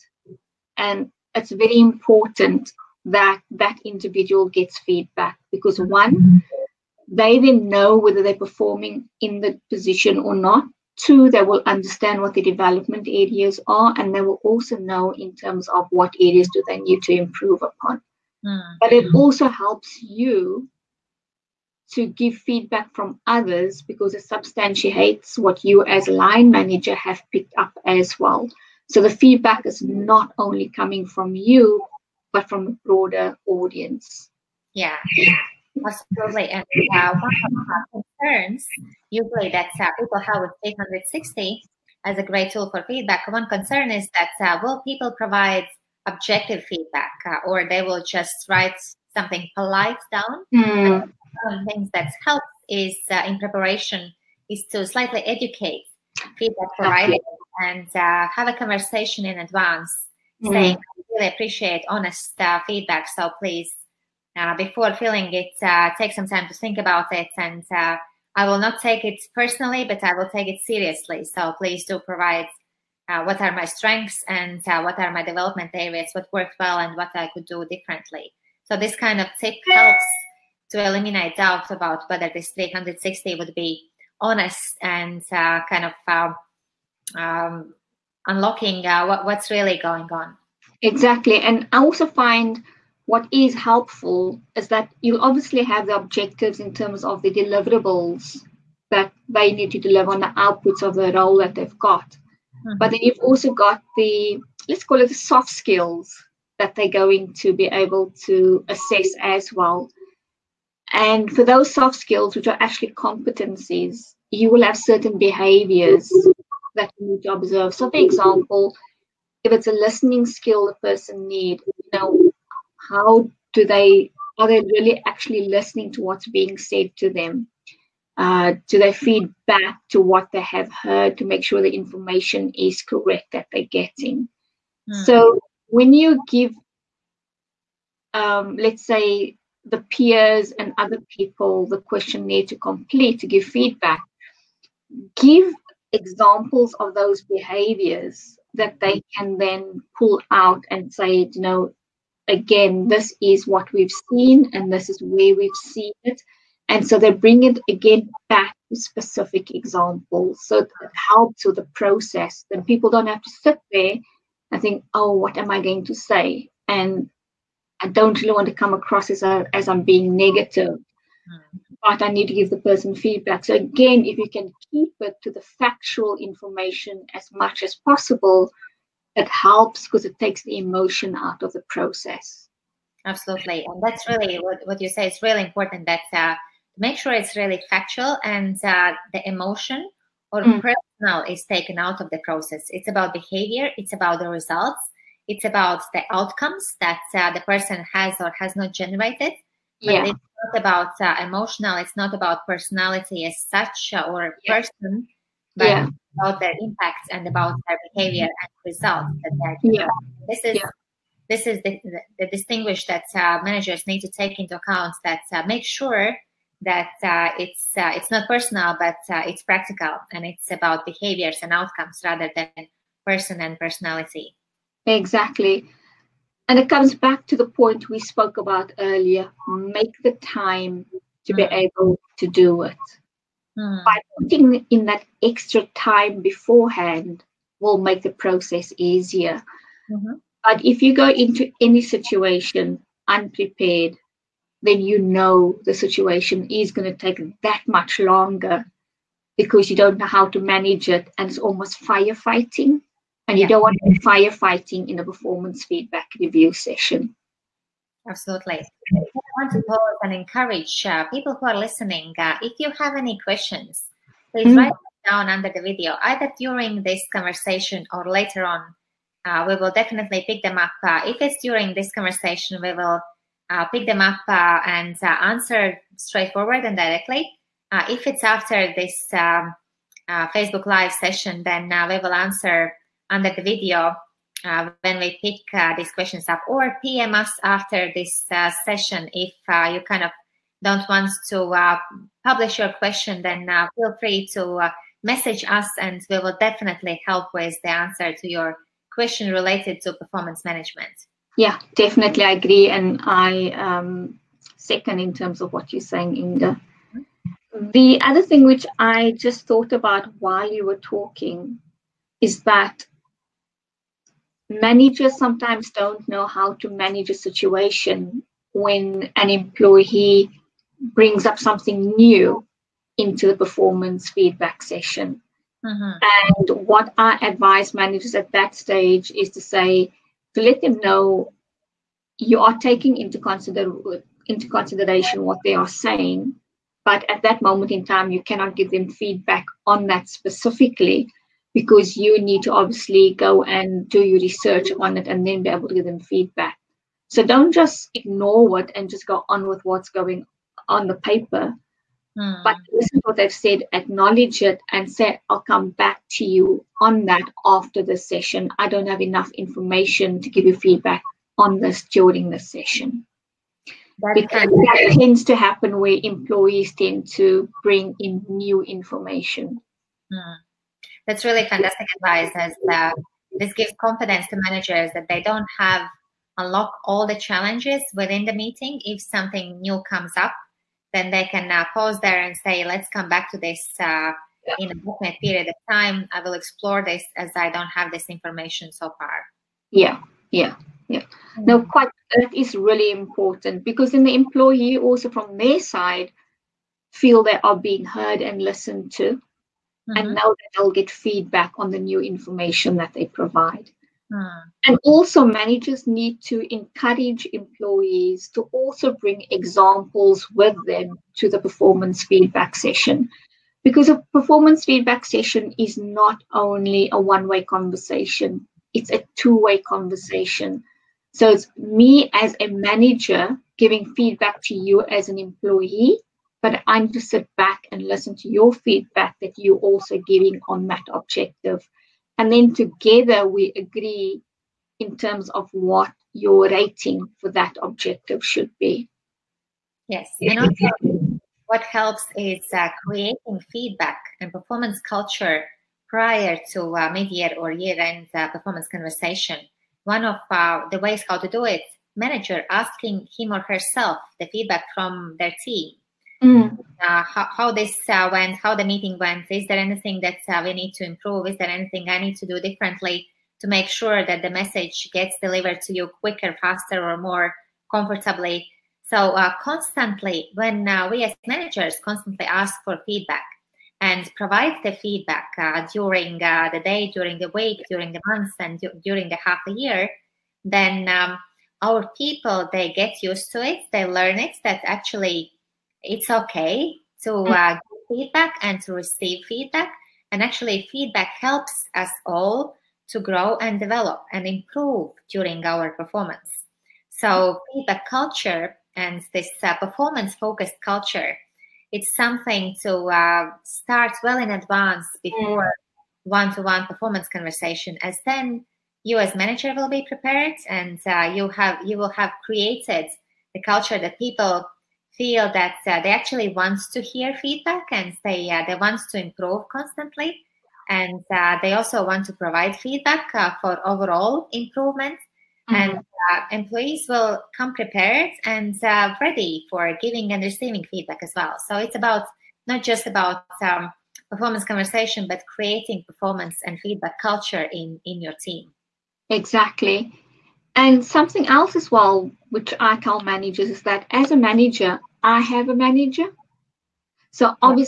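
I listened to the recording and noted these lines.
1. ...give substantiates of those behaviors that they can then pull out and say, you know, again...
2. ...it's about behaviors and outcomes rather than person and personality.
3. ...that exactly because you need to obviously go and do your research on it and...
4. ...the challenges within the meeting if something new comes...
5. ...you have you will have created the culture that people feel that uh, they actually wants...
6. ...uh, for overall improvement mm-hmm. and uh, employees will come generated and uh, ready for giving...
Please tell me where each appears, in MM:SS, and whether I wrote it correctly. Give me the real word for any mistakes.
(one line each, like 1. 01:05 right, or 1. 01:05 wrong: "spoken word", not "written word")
1. 02:25 wrong: "examples", not "substantiates"
2. 03:40 right
3. 05:39 wrong: "specifically", not "exactly"
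4. 06:17 right
5. 08:31 right
6. 08:43 wrong: "prepared", not "generated".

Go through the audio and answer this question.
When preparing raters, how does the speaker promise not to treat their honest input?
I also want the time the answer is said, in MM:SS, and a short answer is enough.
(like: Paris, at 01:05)
take it personally, at 01:08.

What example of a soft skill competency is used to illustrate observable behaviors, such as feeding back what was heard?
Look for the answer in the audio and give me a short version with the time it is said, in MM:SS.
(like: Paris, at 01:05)
listening skill, at 01:59.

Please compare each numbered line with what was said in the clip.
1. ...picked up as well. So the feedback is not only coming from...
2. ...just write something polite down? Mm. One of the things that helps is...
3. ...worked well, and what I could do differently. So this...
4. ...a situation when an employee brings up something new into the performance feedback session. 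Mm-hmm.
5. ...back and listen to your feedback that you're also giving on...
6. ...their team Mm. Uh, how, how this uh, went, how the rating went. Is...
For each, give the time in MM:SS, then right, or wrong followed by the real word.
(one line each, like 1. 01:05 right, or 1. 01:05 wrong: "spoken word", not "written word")
1. 00:27 right
2. 00:48 right
3. 01:16 right
4. 05:17 right
5. 07:07 right
6. 07:35 wrong: "meeting", not "rating".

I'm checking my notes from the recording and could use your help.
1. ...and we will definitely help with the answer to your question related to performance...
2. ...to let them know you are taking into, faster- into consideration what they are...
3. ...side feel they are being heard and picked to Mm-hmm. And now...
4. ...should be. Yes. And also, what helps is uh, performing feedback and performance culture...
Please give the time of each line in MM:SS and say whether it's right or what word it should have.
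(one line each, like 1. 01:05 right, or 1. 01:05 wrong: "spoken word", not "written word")
1. 04:55 right
2. 05:30 wrong: "consider", not "faster"
3. 06:35 wrong: "listened", not "picked"
4. 07:18 wrong: "creating", not "performing".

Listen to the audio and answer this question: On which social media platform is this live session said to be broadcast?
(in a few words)
Facebook.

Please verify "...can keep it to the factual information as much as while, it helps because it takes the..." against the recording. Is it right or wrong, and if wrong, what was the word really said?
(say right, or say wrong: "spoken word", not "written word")
wrong: "possible", not "while".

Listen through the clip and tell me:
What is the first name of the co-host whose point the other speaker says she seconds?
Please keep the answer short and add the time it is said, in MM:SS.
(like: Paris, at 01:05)
Inga, at 05:06.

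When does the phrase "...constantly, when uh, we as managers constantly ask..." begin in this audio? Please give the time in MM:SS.
07:49.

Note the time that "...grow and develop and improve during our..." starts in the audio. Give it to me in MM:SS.
08:13.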